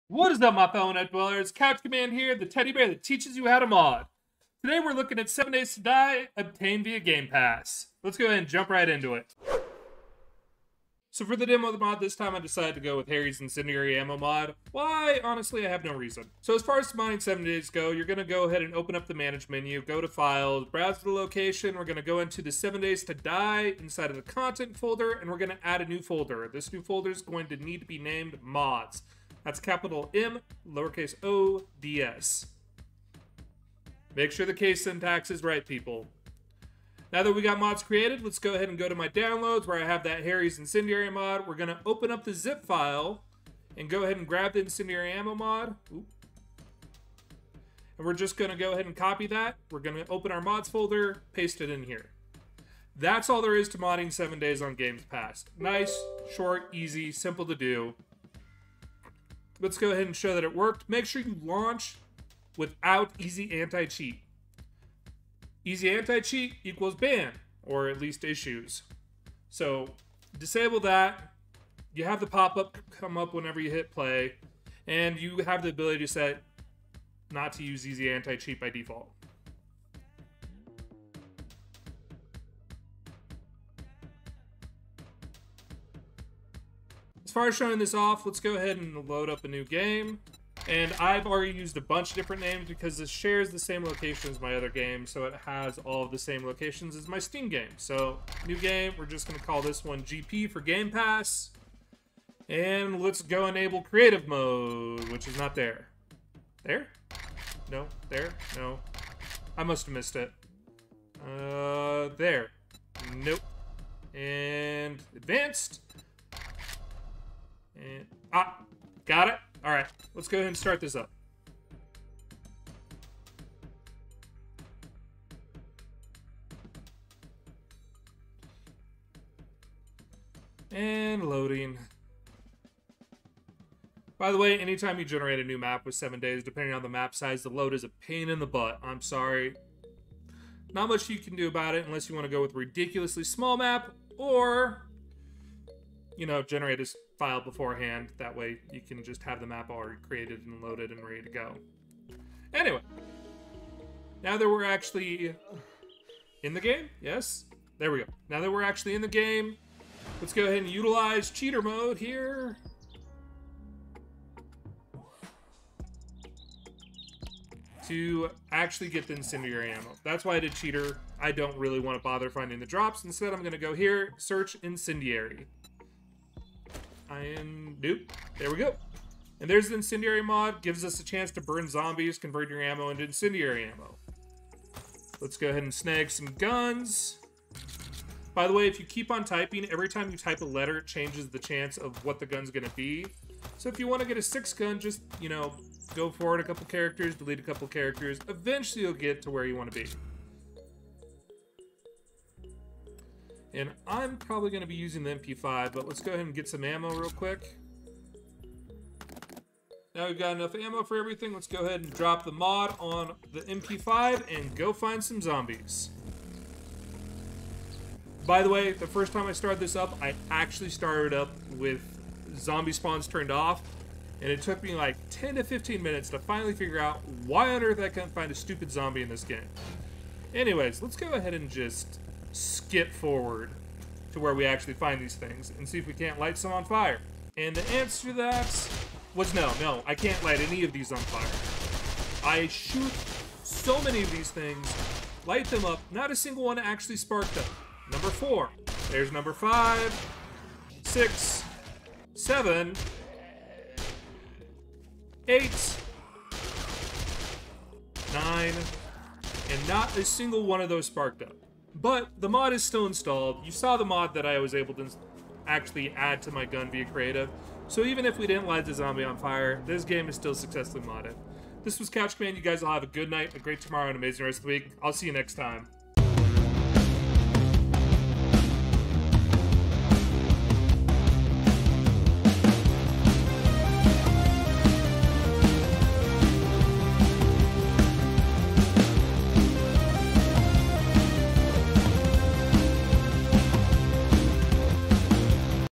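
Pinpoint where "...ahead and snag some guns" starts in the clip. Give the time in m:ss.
3:05.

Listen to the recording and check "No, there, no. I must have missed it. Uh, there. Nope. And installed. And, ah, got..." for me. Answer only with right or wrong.
wrong.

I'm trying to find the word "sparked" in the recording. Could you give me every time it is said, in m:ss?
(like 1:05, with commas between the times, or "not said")
4:06, 4:20.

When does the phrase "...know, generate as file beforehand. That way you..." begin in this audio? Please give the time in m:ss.
2:26.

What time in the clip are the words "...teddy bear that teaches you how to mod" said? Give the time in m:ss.
0:02.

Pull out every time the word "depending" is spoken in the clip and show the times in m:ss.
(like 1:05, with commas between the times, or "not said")
2:16.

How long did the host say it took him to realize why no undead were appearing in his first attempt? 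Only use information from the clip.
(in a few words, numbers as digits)
10 to 15 minutes.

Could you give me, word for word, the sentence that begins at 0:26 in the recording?
This new folder is going to need to be named Mods.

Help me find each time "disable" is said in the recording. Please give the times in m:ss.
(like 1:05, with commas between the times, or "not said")
1:10.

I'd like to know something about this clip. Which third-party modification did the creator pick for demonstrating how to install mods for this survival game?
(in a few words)
Harry's Incendiary Ammo.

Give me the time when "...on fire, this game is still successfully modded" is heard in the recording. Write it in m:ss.
4:29.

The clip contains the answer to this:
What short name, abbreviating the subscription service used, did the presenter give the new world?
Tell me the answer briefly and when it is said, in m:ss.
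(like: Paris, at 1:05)
GP, at 1:40.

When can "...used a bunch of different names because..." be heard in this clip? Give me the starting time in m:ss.
1:31.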